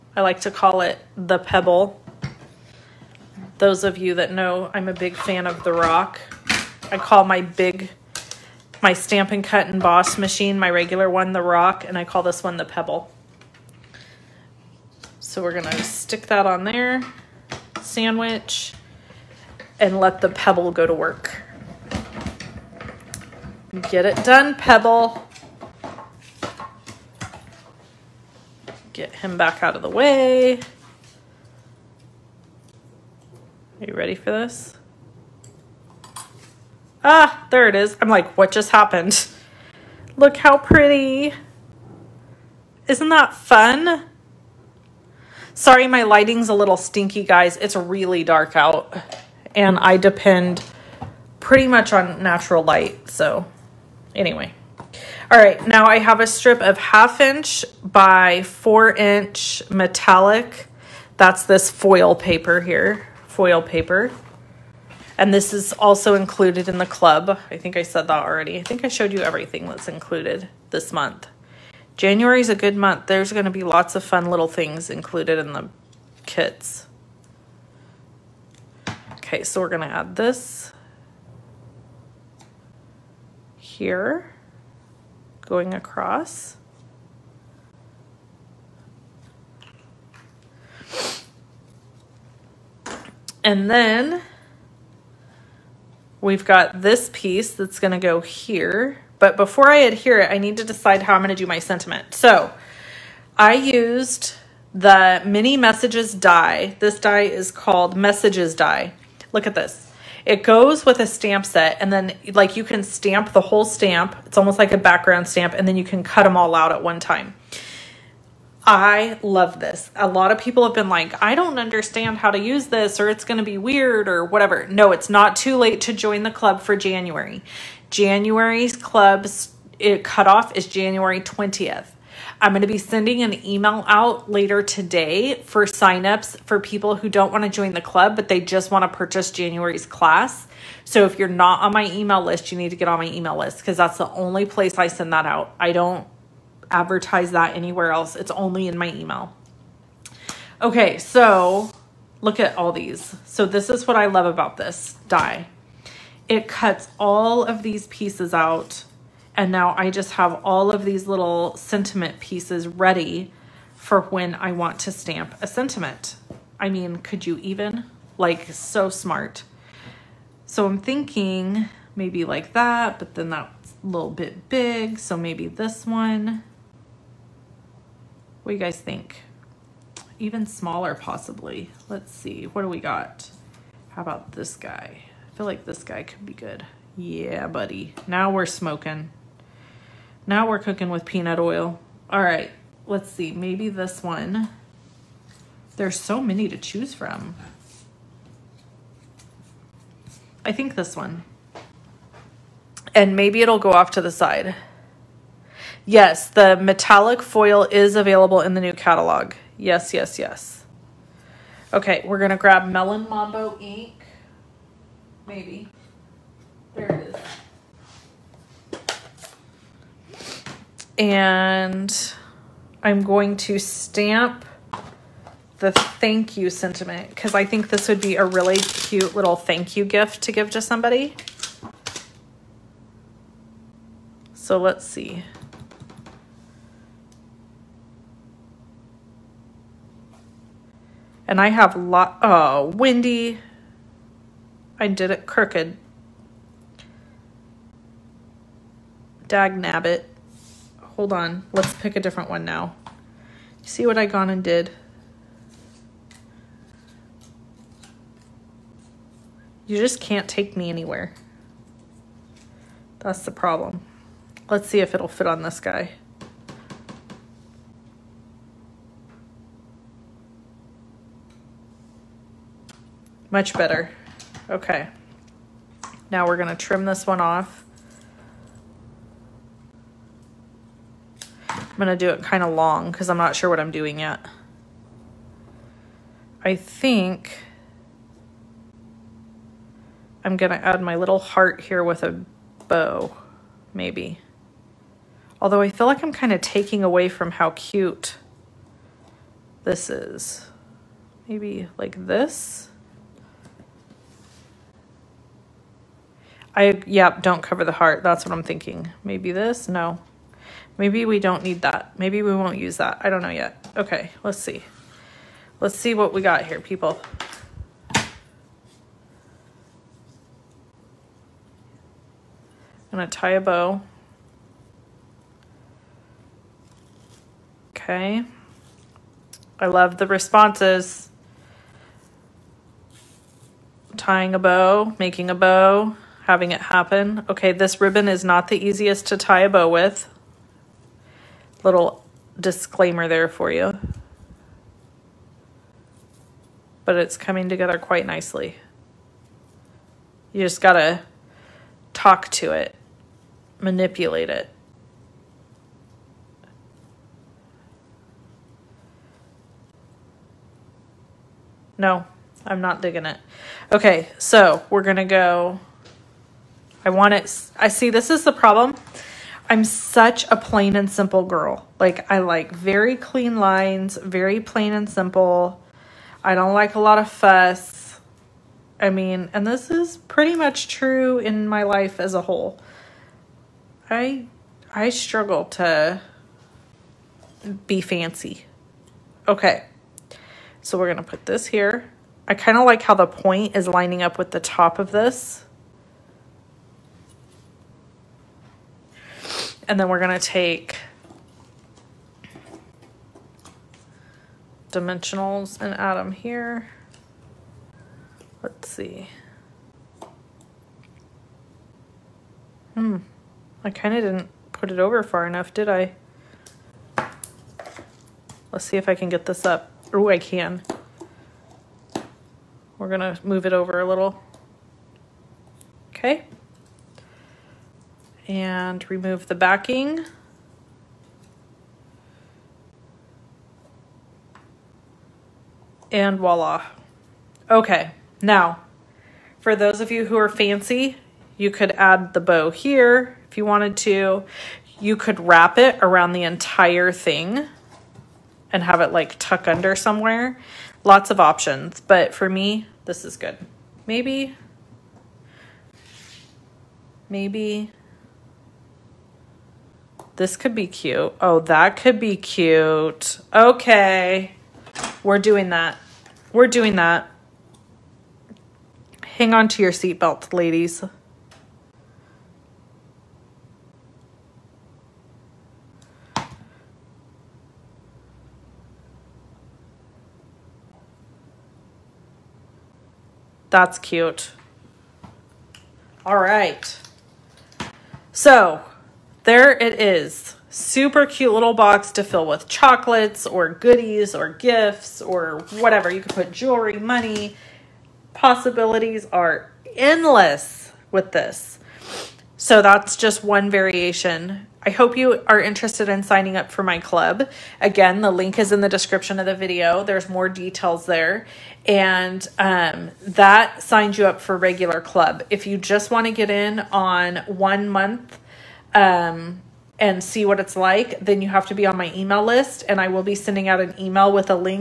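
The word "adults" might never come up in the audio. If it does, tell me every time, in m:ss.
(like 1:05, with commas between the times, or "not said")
not said.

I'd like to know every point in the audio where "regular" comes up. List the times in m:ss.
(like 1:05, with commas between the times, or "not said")
0:10, 8:34.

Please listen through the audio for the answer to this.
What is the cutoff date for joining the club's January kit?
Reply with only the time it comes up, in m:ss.
2:10.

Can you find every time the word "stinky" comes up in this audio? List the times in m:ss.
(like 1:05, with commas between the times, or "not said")
0:46.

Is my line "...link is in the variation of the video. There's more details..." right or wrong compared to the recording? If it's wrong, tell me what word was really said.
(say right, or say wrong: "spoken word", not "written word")
wrong: "description", not "variation".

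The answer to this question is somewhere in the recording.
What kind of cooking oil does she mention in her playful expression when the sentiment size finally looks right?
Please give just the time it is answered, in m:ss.
3:11.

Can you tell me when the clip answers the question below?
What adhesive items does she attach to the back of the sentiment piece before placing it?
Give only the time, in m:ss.
6:44.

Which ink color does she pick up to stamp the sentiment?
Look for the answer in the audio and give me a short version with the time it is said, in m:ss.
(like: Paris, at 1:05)
Melon Mambo, at 3:32.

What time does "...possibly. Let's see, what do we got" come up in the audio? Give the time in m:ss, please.
3:00.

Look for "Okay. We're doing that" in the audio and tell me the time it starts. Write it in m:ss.
7:43.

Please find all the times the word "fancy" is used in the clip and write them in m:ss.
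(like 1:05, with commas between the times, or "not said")
6:27, 7:20.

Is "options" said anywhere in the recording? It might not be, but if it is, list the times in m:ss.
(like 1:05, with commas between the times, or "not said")
7:31.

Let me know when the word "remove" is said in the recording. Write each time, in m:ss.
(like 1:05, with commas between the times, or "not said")
7:08.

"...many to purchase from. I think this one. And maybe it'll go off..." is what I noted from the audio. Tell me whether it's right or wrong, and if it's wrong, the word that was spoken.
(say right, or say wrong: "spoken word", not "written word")
wrong: "choose", not "purchase".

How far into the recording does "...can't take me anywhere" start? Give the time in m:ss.
4:20.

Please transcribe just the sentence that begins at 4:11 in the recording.
Let's pick a different one now.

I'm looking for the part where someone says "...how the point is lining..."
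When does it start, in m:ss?
6:32.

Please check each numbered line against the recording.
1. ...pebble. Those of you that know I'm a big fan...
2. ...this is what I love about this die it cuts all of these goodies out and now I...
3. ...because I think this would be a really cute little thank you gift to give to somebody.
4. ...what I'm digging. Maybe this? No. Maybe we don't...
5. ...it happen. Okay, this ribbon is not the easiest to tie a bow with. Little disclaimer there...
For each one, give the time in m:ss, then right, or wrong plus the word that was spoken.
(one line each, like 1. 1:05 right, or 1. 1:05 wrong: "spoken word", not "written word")
1. 0:01 right
2. 2:33 wrong: "pieces", not "goodies"
3. 3:47 right
4. 5:08 wrong: "thinking", not "digging"
5. 5:36 right.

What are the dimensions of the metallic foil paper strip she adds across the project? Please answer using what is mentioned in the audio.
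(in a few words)
half inch by 4 inch.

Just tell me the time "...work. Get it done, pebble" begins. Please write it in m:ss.
0:20.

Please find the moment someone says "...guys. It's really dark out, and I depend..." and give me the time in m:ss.
0:47.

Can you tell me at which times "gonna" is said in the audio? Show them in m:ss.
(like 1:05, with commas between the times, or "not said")
0:15, 5:22, 6:04, 6:40.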